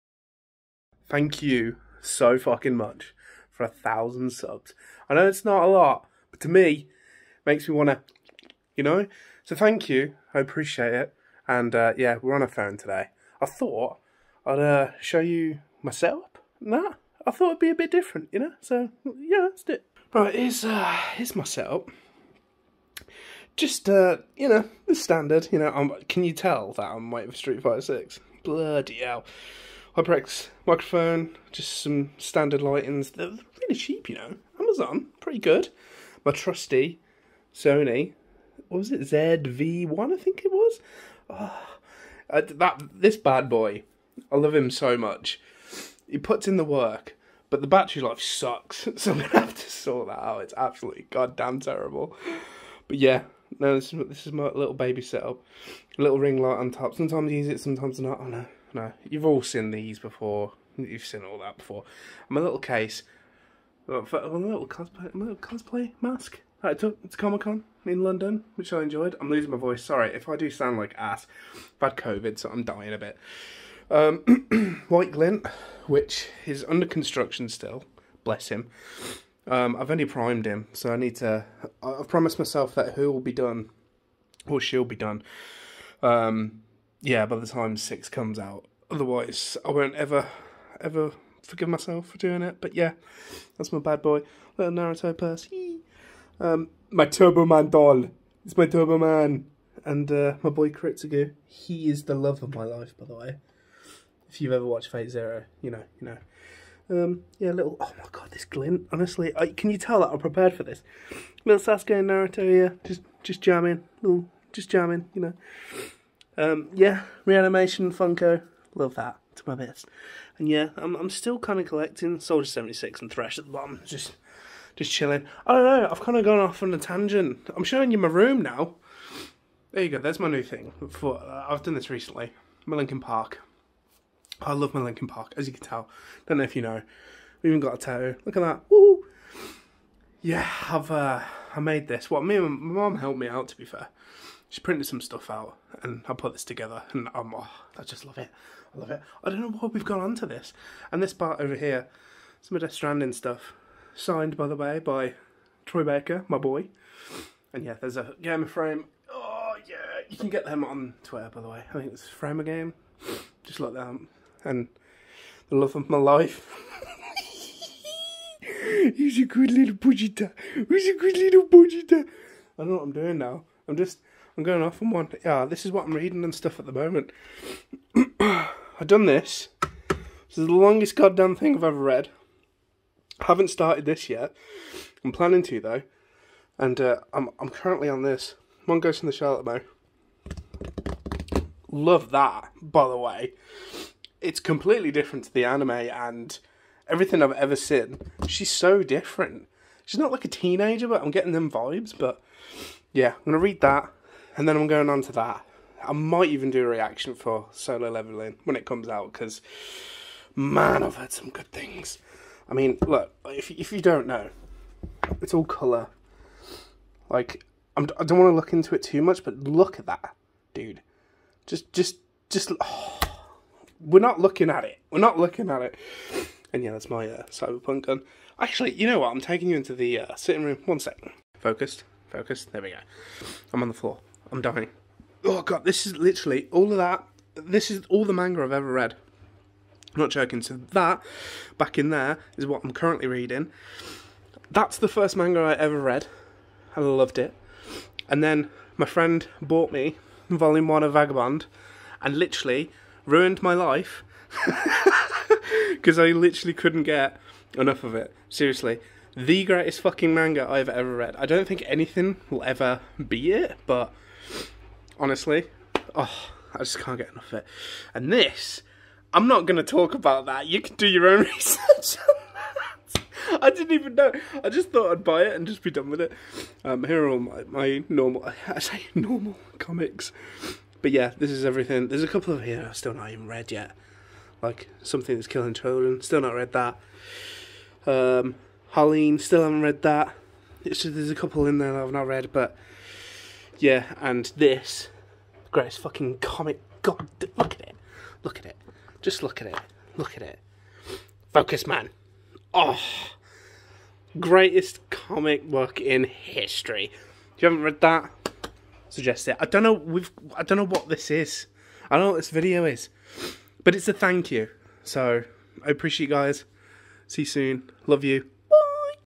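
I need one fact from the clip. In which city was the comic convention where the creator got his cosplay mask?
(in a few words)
London.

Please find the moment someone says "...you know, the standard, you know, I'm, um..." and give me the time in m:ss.
0:24.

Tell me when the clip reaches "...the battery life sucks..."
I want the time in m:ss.
0:47.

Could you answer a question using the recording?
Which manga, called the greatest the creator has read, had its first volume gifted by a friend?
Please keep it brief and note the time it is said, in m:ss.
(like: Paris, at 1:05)
Vagabond, at 4:10.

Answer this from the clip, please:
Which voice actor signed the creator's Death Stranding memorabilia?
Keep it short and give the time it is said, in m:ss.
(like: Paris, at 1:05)
Troy Baker, at 2:35.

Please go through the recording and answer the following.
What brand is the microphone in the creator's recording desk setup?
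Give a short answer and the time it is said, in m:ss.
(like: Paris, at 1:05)
HyperX, at 0:29.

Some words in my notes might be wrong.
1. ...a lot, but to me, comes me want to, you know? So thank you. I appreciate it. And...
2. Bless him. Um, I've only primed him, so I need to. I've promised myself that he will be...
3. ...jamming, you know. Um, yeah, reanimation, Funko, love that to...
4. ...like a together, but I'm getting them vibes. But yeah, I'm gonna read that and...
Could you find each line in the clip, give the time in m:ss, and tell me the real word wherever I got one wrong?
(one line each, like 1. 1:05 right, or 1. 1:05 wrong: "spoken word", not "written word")
1. 0:05 wrong: "makes", not "comes"
2. 1:18 right
3. 1:54 right
4. 3:20 wrong: "teenager", not "together".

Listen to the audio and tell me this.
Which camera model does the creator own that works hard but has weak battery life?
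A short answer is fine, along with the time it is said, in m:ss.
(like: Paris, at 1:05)
ZV1, at 0:39.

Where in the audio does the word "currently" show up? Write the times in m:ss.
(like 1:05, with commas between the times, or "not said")
3:07, 4:02.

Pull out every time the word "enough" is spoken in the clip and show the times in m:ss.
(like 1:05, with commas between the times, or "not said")
4:17, 4:27.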